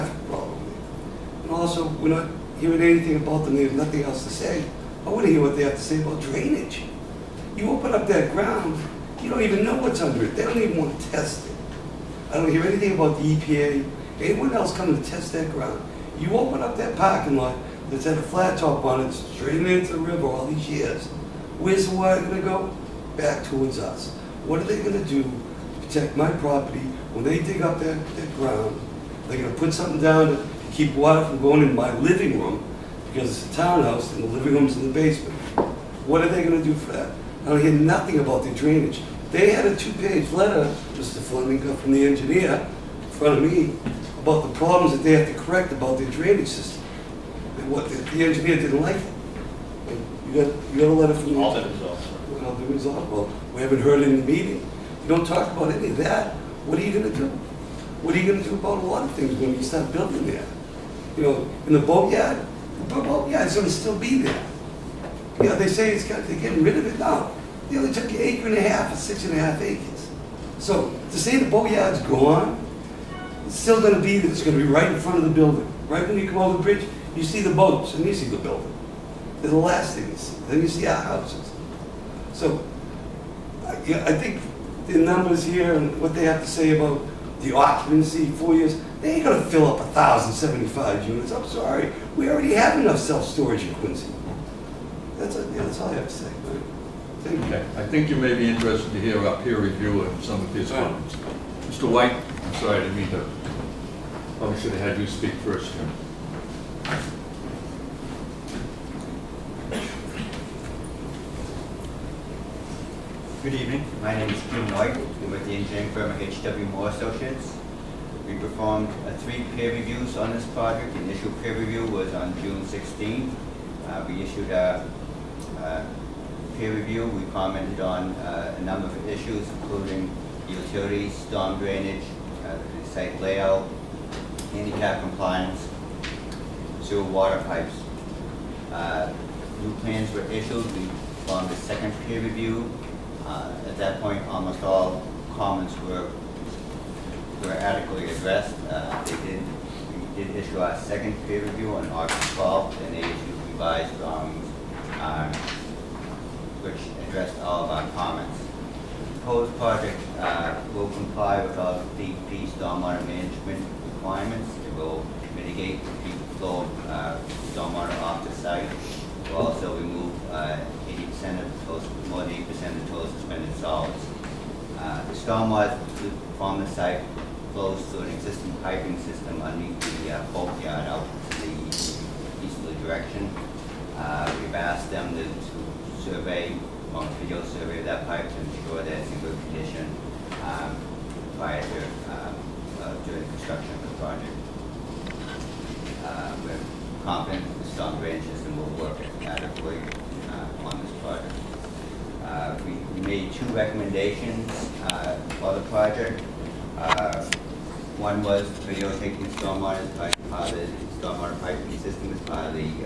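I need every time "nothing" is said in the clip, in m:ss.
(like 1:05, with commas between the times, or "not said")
0:03, 0:37.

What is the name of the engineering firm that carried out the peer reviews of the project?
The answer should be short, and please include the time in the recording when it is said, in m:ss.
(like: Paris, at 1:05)
HW Moore Associates, at 1:56.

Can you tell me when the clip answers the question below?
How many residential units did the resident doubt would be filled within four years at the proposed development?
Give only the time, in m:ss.
1:29.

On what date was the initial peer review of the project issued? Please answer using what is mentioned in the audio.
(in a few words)
June 16.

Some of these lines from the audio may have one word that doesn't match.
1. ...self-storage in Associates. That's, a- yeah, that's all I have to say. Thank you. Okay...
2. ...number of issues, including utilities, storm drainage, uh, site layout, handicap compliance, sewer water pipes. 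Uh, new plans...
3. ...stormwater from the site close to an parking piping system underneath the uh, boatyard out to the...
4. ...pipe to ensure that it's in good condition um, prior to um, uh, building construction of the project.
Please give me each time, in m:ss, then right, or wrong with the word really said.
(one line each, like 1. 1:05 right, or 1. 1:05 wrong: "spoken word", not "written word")
1. 1:32 wrong: "Quincy", not "Associates"
2. 2:08 right
3. 2:55 wrong: "existing", not "parking"
4. 3:08 wrong: "during", not "building".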